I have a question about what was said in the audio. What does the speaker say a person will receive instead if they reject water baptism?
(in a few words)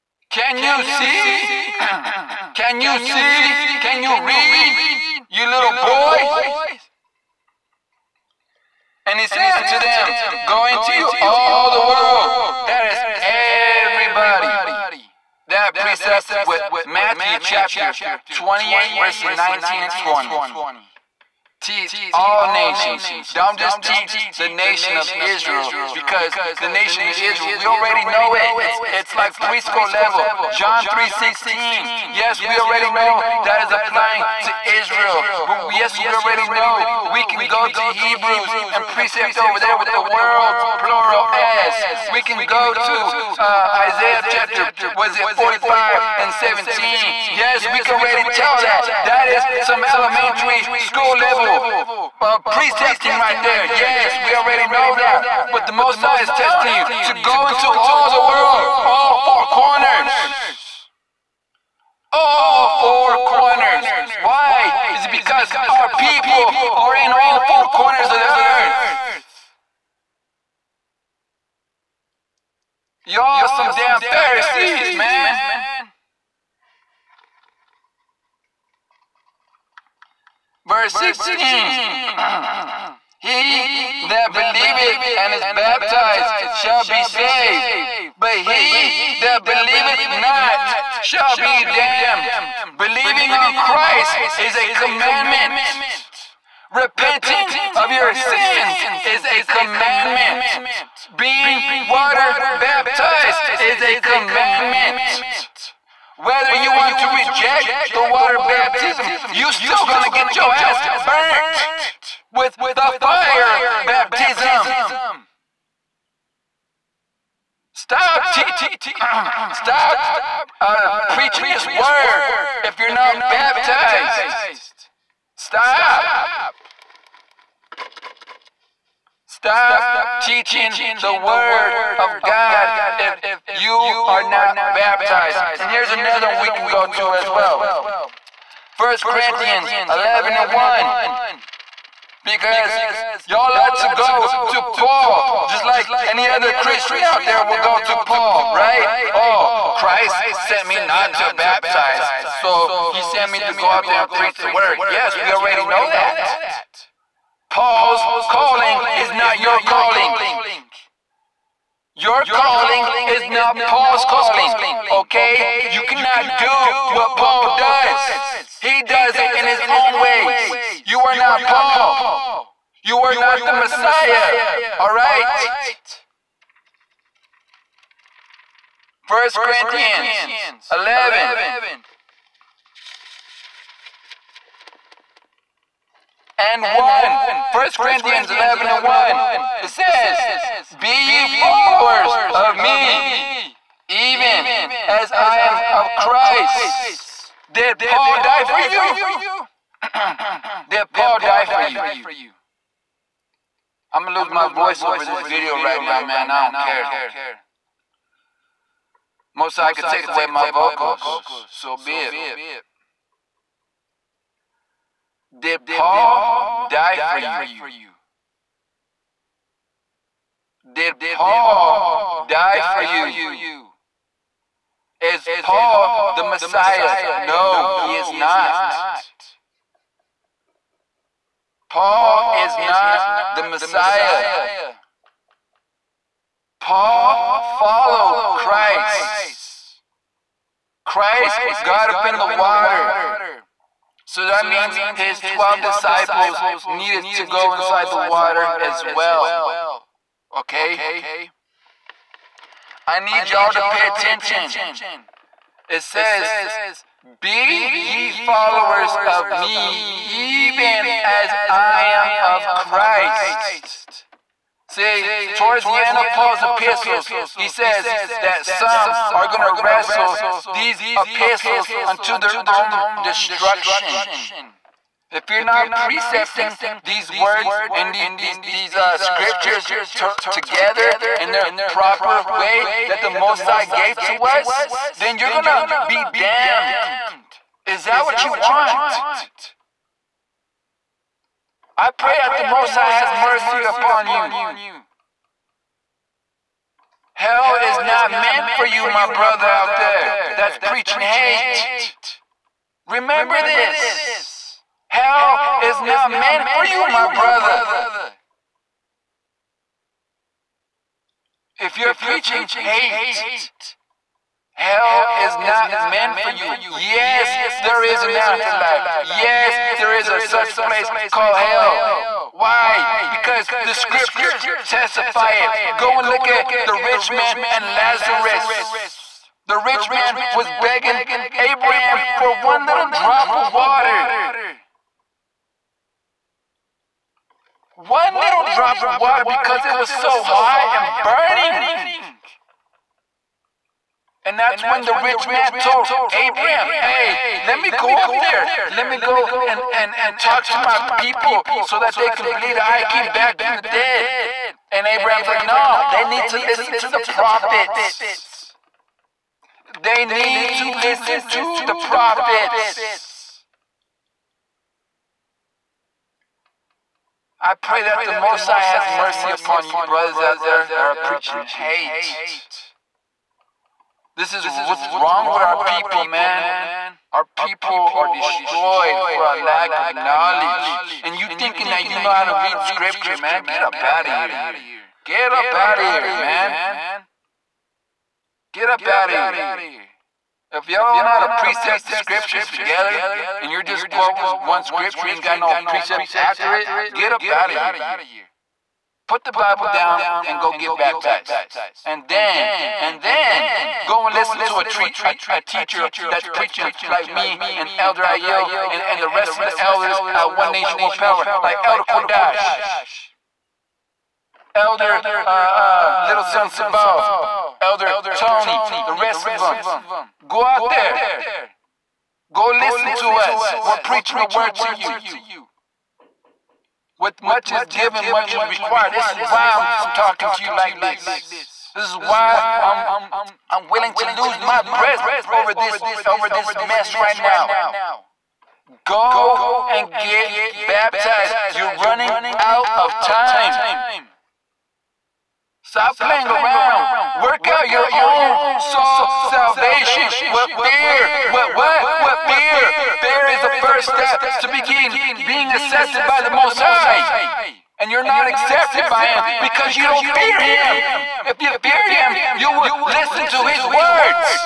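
the fire baptism.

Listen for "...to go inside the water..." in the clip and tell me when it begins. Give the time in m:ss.
4:07.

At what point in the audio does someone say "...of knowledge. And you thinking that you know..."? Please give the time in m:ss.
6:19.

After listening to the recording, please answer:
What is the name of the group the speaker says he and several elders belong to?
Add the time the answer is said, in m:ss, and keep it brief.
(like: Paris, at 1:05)
One Nation, One Power, at 6:50.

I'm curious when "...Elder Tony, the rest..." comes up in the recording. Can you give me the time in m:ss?
6:57.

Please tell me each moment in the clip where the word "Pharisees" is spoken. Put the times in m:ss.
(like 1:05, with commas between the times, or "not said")
1:14.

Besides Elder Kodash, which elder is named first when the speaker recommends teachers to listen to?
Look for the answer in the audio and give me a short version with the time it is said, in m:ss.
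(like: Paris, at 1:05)
Elder Ayo, at 6:47.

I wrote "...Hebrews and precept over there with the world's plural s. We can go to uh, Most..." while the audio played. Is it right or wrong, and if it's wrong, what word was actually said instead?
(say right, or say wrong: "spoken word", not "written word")
wrong: "Isaiah", not "Most".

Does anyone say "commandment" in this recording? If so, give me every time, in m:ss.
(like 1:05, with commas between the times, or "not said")
1:34, 1:39, 1:43.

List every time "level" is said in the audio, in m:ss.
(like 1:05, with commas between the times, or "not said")
0:29, 0:51.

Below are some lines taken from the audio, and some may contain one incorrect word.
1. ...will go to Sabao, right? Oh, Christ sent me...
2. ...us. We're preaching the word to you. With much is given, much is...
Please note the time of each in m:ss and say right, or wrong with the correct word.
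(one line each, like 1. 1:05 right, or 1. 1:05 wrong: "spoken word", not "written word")
1. 2:27 wrong: "Paul", not "Sabao"
2. 7:03 right.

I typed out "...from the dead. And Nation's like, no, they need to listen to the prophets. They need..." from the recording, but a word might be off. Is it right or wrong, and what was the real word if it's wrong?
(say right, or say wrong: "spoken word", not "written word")
wrong: "Abraham", not "Nation".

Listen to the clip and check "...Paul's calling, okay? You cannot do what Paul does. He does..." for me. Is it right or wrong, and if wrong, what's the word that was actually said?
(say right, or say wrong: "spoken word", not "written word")
right.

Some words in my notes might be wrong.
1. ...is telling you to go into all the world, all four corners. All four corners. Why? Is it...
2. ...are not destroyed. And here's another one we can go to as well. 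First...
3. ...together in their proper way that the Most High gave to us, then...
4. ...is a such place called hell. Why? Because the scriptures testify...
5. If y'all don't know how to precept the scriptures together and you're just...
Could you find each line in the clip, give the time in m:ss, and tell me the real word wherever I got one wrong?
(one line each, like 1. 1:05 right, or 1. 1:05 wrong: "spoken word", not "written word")
1. 0:56 right
2. 2:14 wrong: "baptized", not "destroyed"
3. 4:40 right
4. 5:20 right
5. 6:30 right.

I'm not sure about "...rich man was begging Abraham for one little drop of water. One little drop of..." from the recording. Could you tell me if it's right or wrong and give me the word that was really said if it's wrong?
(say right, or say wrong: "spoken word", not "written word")
right.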